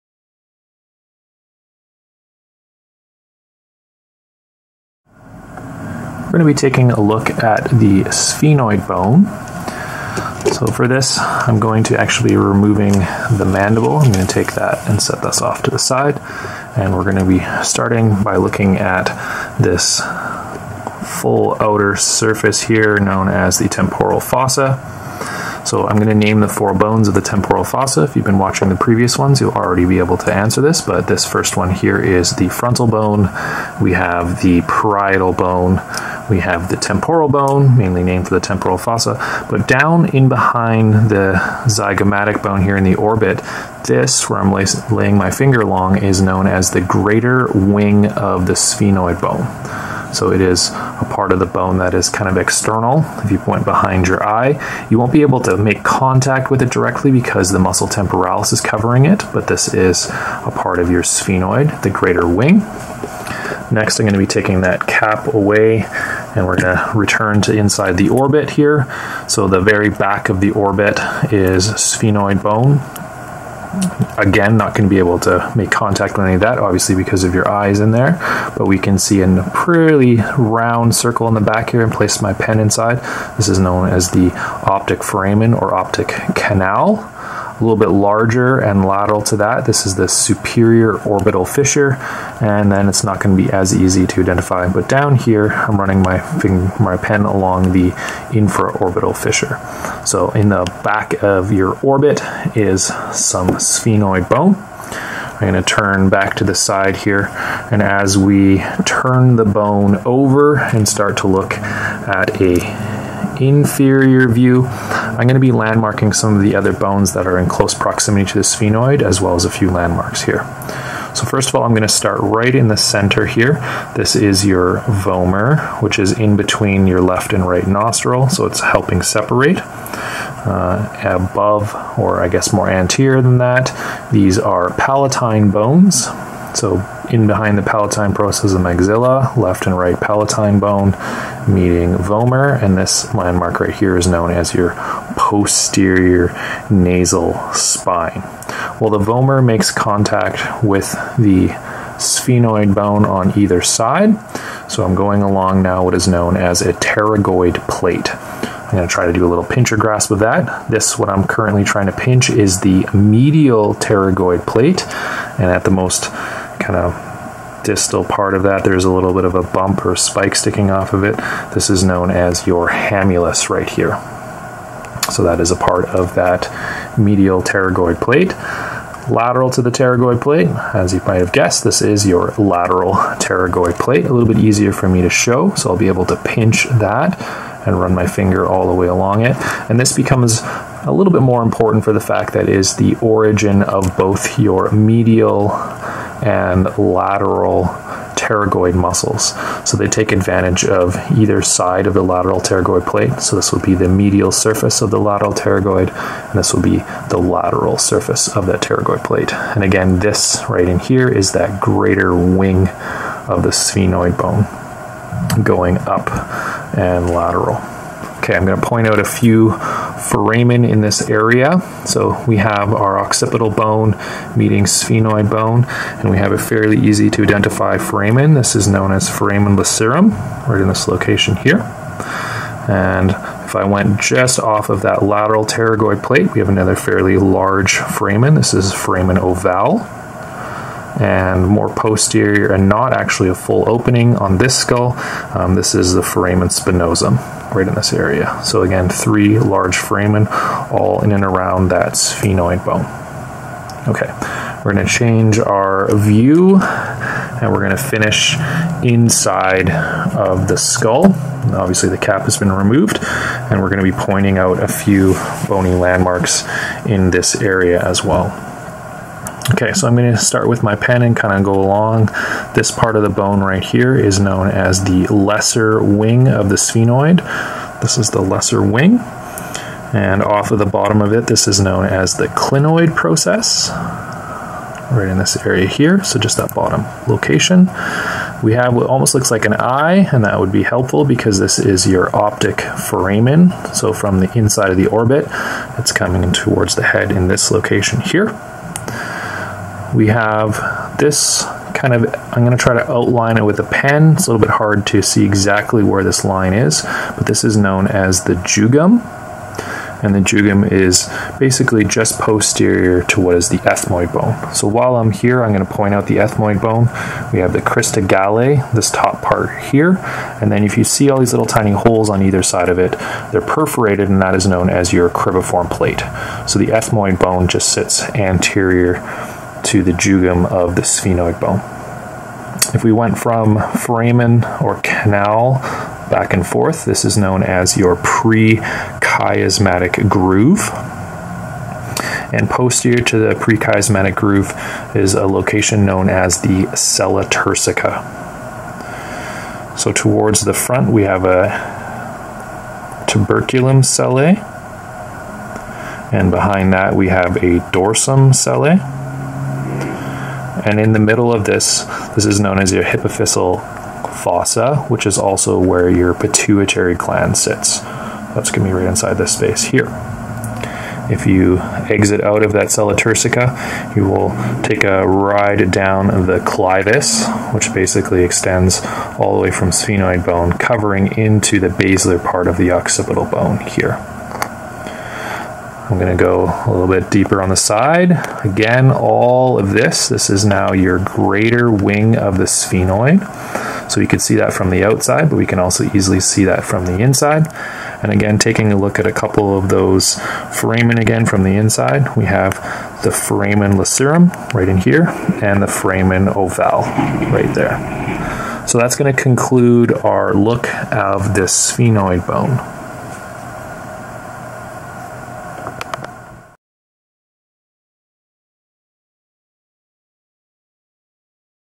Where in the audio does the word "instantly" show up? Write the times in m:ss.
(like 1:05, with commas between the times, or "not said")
not said.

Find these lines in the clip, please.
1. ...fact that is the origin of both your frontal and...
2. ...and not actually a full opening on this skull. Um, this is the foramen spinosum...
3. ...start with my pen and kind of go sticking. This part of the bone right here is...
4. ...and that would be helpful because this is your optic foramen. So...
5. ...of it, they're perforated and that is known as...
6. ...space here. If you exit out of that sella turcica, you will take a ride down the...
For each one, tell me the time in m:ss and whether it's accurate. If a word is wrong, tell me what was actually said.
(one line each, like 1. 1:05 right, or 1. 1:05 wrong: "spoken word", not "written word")
1. 3:11 wrong: "medial", not "frontal"
2. 4:02 right
3. 4:30 wrong: "along", not "sticking"
4. 4:50 right
5. 5:22 right
6. 6:09 right.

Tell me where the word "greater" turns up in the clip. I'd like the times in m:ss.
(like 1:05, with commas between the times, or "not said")
0:46, 1:01, 3:31, 6:31.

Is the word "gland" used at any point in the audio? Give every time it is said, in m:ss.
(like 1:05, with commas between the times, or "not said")
6:06.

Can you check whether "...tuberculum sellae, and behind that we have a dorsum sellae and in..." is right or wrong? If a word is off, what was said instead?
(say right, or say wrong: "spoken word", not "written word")
right.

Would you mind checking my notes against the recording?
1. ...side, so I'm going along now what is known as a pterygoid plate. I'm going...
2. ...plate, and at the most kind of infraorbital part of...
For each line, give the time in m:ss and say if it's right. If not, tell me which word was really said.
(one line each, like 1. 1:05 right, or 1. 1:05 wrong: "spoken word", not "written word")
1. 2:33 right
2. 2:44 wrong: "distal", not "infraorbital".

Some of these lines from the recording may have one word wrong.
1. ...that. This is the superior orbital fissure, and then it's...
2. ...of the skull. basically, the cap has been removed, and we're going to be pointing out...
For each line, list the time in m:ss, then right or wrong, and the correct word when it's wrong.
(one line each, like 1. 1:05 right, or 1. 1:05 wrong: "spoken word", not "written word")
1. 1:29 right
2. 4:20 wrong: "obviously", not "basically".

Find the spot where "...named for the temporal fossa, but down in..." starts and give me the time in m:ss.
0:38.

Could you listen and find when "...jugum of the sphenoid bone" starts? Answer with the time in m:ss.
5:29.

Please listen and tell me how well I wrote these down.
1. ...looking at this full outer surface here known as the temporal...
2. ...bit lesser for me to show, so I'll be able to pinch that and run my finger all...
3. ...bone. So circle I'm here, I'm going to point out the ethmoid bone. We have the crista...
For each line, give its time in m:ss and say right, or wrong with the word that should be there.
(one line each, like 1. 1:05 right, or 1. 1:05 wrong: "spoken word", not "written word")
1. 0:18 right
2. 3:04 wrong: "easier", not "lesser"
3. 5:14 wrong: "while", not "circle".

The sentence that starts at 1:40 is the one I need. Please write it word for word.
So in the back of your orbit is some sphenoid bone.